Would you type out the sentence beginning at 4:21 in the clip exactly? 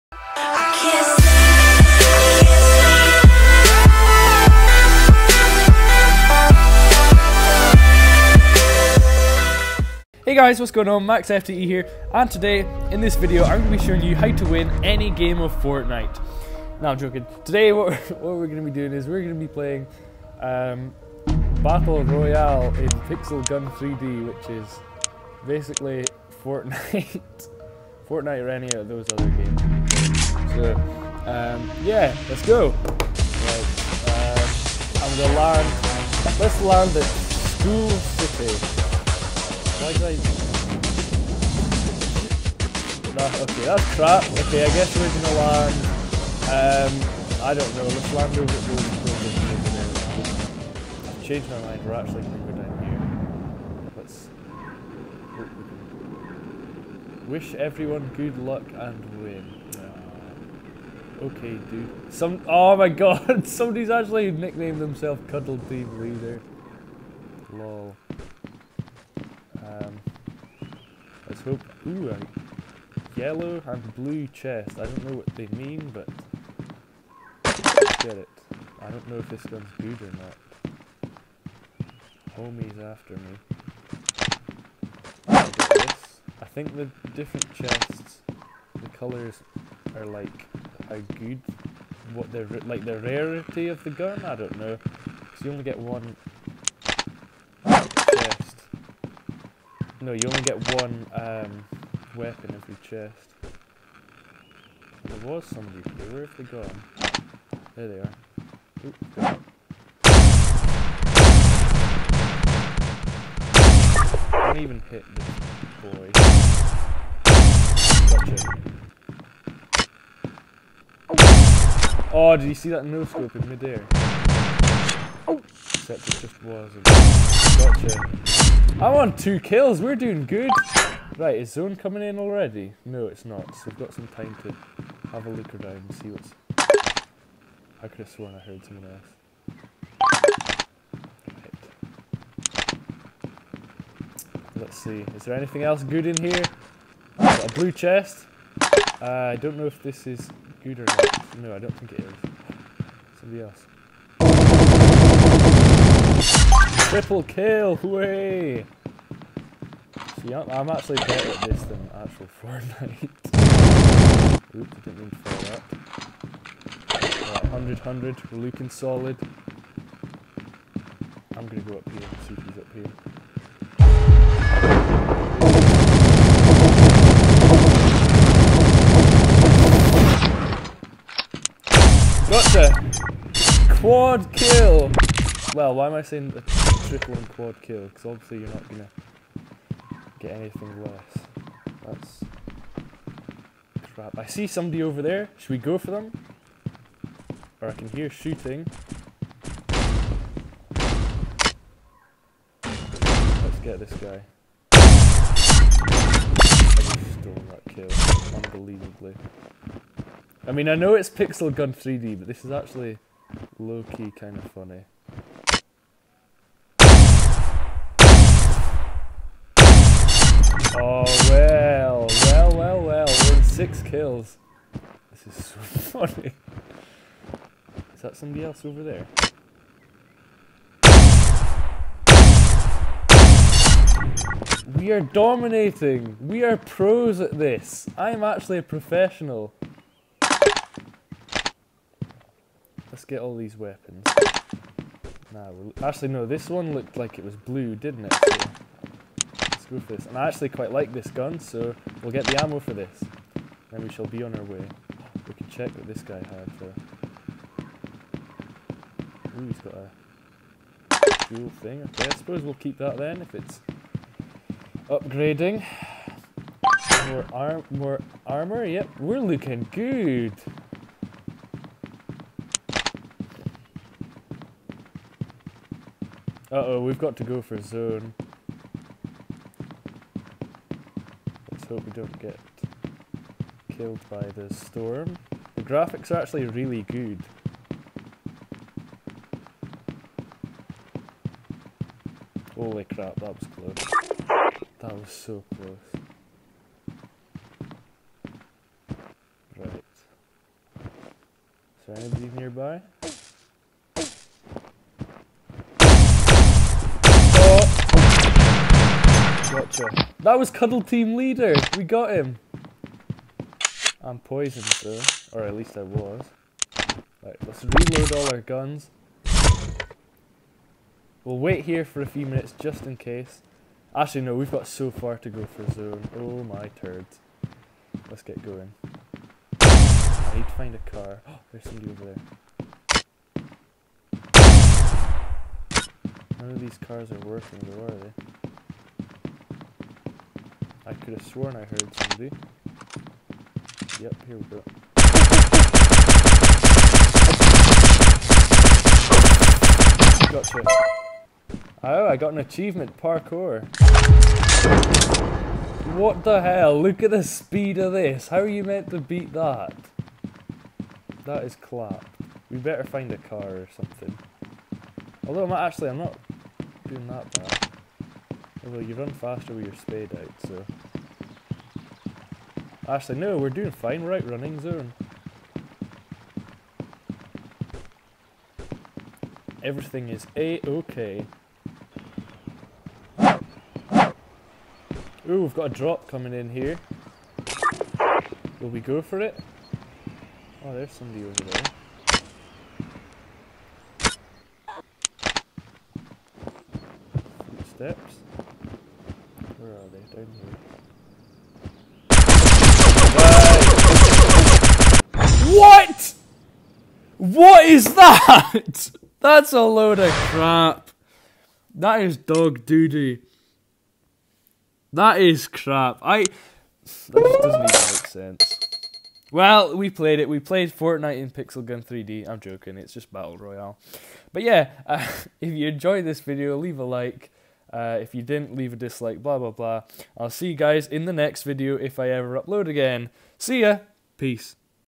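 Okay, I suppose we'll keep that then if it's upgrading.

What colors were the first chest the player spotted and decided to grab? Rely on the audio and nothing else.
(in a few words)
yellow and blue.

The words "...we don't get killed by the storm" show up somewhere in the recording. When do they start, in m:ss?
4:41.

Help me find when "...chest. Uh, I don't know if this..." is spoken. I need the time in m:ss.
2:27.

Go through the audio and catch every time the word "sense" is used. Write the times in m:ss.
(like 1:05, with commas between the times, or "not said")
6:57.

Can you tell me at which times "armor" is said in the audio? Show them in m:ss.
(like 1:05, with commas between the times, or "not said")
4:28.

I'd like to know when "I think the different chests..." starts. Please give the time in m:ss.
1:26.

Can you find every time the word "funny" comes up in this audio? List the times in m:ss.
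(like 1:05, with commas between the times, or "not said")
3:34, 3:45.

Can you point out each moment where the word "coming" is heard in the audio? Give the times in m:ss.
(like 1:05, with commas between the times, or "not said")
2:11, 6:26.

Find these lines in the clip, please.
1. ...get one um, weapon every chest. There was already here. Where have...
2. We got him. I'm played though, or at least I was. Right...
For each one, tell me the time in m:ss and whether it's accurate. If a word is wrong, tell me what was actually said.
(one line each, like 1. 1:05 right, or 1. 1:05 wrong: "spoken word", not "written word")
1. 1:40 wrong: "somebody", not "already"
2. 5:11 wrong: "poisoned", not "played".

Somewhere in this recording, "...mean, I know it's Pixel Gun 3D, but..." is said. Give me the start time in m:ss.
3:30.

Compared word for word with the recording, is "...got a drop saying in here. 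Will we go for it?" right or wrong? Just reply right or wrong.
wrong.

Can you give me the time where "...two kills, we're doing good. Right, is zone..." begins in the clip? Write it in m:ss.
2:09.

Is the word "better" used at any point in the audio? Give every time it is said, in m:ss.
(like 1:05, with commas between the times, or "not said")
2:40, 6:02.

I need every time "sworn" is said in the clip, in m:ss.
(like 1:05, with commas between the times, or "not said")
2:18, 5:41.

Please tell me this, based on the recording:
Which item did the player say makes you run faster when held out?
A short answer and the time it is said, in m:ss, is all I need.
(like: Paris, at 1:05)
spade, at 6:09.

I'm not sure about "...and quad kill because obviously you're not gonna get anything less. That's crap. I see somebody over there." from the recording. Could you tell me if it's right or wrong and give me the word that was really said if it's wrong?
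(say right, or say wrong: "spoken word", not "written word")
right.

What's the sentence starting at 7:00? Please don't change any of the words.
We played Fortnite in Pixel Gun 3D.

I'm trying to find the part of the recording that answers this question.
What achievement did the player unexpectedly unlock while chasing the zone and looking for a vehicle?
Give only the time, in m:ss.
5:53.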